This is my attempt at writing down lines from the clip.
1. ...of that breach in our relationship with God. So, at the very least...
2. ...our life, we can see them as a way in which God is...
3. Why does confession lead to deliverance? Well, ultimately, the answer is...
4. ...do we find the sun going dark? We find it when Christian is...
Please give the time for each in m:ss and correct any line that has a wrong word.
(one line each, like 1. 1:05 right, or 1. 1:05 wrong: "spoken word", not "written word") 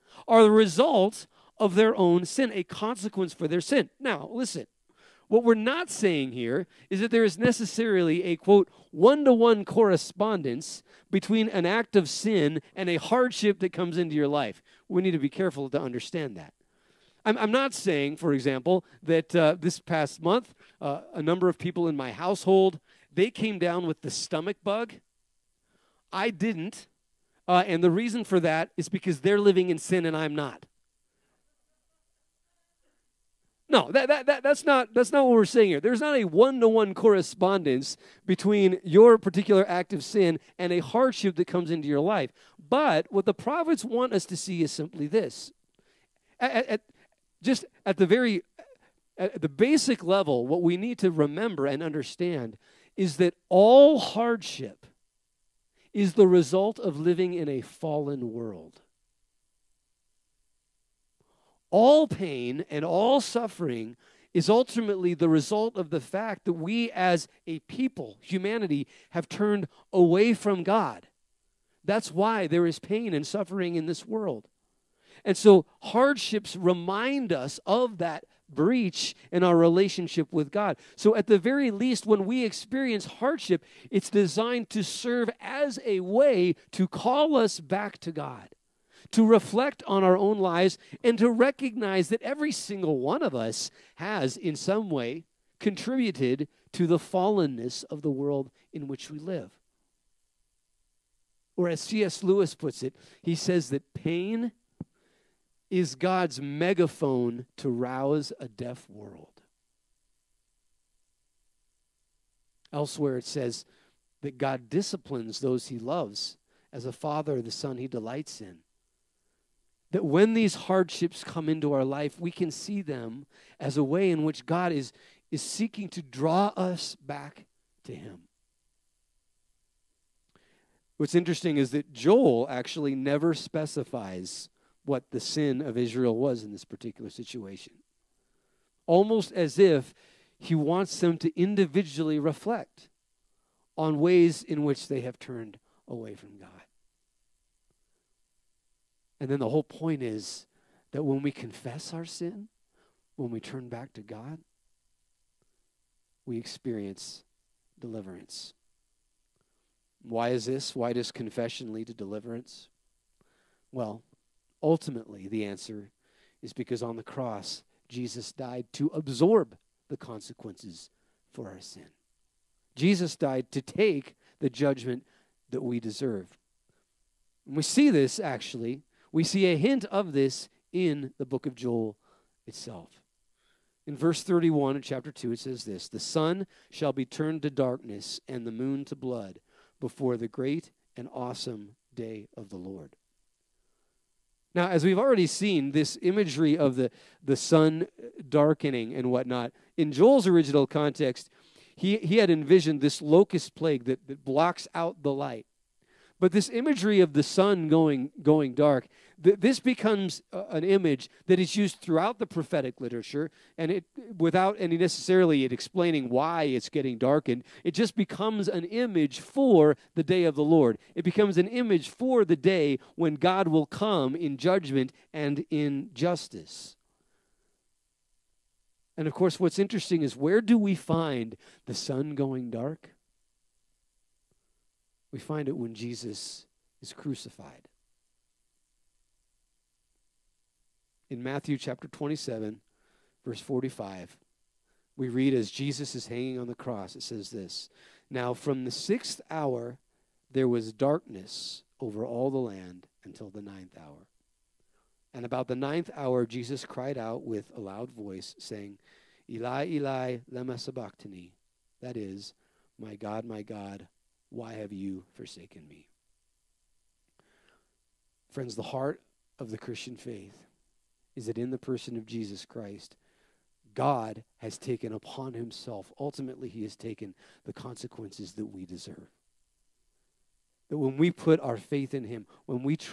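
1. 1:17 right
2. 2:01 right
3. 2:40 right
4. 3:50 wrong: "Jesus", not "Christian".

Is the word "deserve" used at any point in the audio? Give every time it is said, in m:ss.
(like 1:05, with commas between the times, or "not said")
2:55, 4:38.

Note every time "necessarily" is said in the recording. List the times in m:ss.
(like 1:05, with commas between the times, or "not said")
0:07, 3:34.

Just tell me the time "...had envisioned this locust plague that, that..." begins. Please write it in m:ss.
3:22.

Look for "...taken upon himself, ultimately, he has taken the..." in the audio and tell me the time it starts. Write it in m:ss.
4:34.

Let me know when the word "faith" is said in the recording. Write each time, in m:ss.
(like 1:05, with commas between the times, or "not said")
4:29, 4:41.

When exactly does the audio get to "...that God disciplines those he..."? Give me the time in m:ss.
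1:54.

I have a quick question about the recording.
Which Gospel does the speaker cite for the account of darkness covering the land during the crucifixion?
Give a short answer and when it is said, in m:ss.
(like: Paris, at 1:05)
Matthew, at 4:01.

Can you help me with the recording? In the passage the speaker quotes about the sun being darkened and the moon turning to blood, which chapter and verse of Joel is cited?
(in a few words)
Chapter 2, verse 31.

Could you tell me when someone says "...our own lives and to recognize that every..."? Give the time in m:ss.
1:30.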